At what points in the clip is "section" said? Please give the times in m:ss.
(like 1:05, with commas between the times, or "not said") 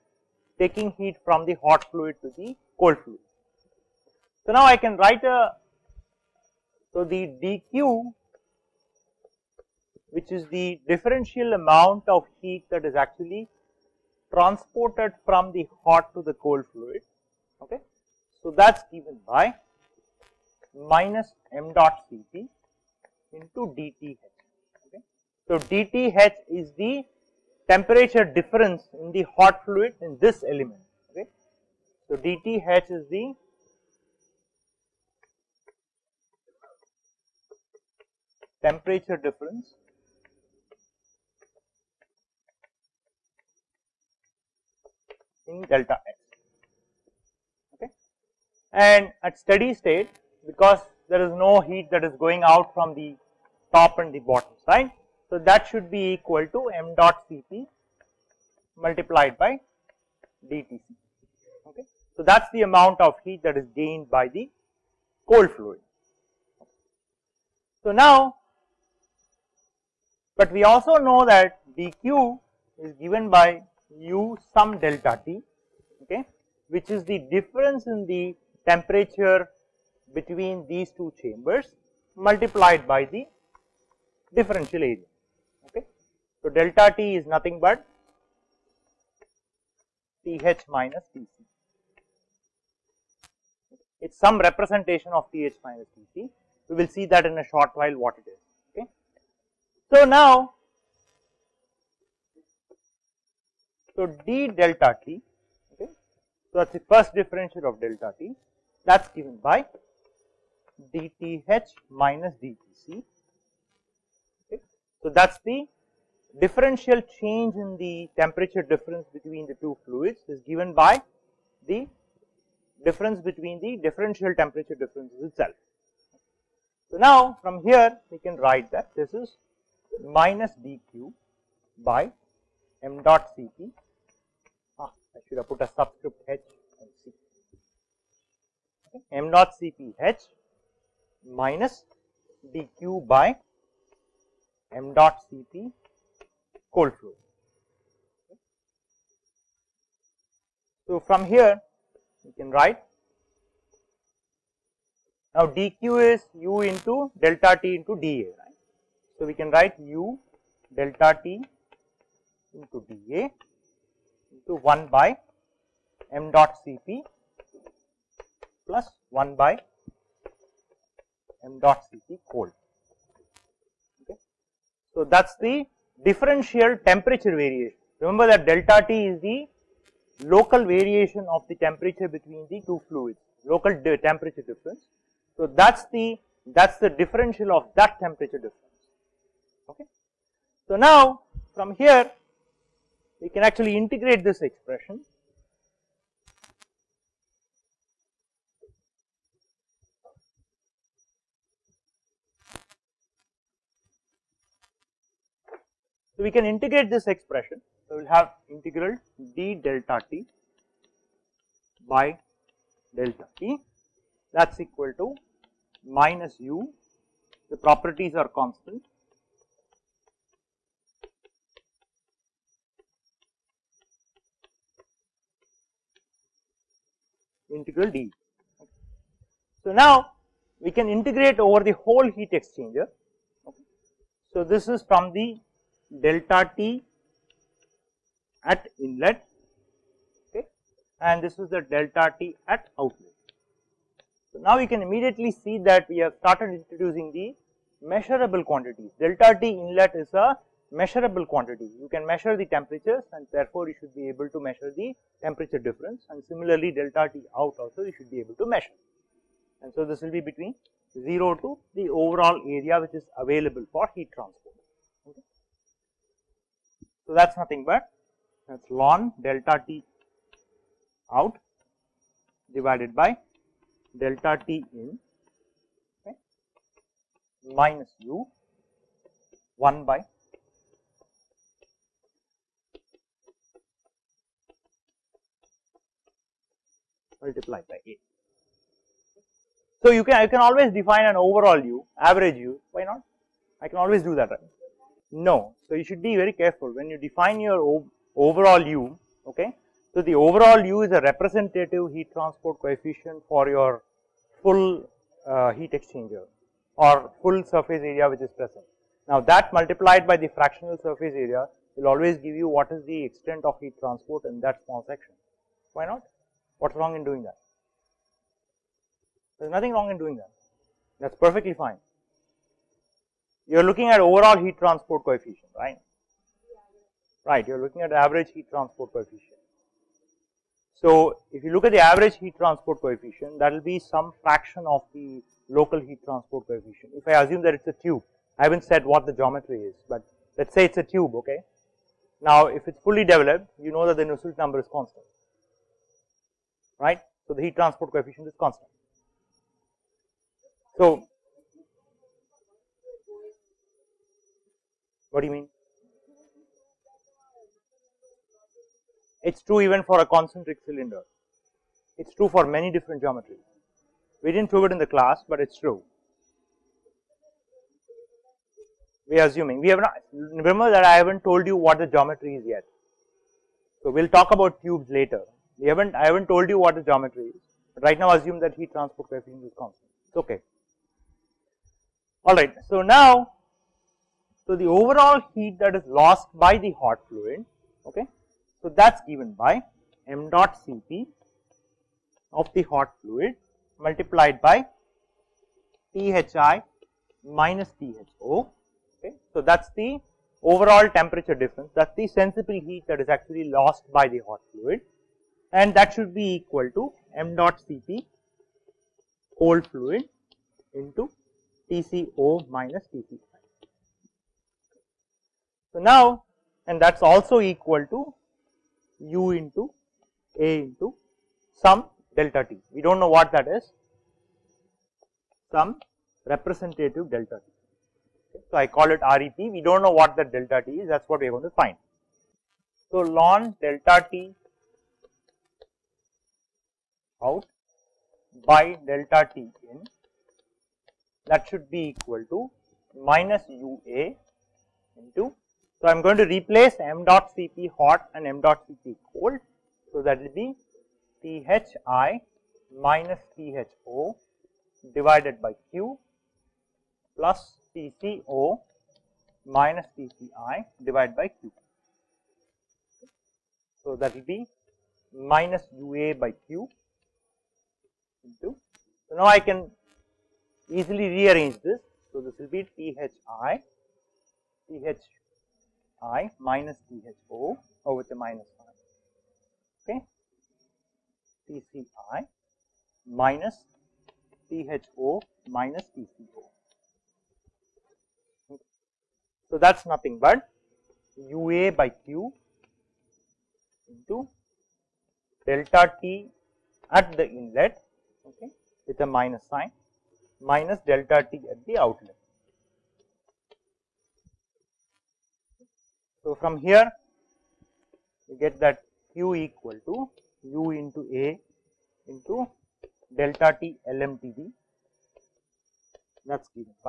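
5:14.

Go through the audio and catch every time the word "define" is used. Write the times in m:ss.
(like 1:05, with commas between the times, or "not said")
4:50, 4:56.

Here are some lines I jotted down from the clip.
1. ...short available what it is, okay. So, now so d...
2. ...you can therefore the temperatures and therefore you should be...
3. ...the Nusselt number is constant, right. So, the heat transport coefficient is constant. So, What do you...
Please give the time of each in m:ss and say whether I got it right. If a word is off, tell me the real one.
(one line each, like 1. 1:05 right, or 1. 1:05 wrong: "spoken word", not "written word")
1. 1:37 wrong: "while", not "available"
2. 4:11 wrong: "measure", not "therefore"
3. 5:43 right.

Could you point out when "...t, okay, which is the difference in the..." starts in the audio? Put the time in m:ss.
1:15.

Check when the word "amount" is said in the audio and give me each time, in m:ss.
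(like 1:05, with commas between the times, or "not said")
0:11, 1:02.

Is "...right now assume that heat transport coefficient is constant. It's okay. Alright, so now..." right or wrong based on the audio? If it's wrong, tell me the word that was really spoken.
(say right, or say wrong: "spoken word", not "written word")
right.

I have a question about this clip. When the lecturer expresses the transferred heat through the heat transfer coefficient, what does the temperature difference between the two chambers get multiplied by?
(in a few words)
the differential area.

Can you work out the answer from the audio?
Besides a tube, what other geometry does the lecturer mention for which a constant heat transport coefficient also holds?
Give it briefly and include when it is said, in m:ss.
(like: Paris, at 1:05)
concentric cylinder, at 6:00.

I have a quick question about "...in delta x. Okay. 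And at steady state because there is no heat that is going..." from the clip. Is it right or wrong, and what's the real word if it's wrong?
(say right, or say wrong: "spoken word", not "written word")
right.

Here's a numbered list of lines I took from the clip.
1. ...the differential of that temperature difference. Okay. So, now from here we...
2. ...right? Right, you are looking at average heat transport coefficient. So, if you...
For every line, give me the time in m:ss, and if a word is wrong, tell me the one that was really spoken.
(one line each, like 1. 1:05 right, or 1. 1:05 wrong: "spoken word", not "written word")
1. 3:06 right
2. 5:25 right.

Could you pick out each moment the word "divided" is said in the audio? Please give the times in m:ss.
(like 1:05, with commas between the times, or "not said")
4:32, 7:34, 7:40.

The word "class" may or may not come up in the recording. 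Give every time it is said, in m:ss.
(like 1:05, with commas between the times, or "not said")
6:04.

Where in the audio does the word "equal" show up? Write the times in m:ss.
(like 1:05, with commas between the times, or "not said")
0:56, 3:34, 6:46, 6:57, 7:21, 8:29.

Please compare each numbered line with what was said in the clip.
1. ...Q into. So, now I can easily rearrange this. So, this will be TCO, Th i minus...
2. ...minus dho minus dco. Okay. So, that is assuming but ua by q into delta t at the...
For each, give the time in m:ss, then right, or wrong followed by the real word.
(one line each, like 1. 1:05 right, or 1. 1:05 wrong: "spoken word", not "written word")
1. 7:46 wrong: "Thi", not "TCO"
2. 8:03 wrong: "nothing", not "assuming".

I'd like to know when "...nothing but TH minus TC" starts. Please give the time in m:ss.
1:27.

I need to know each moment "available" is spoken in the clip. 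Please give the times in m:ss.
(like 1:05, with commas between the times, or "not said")
4:23.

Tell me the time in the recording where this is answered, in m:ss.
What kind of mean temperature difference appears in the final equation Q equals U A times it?
8:33.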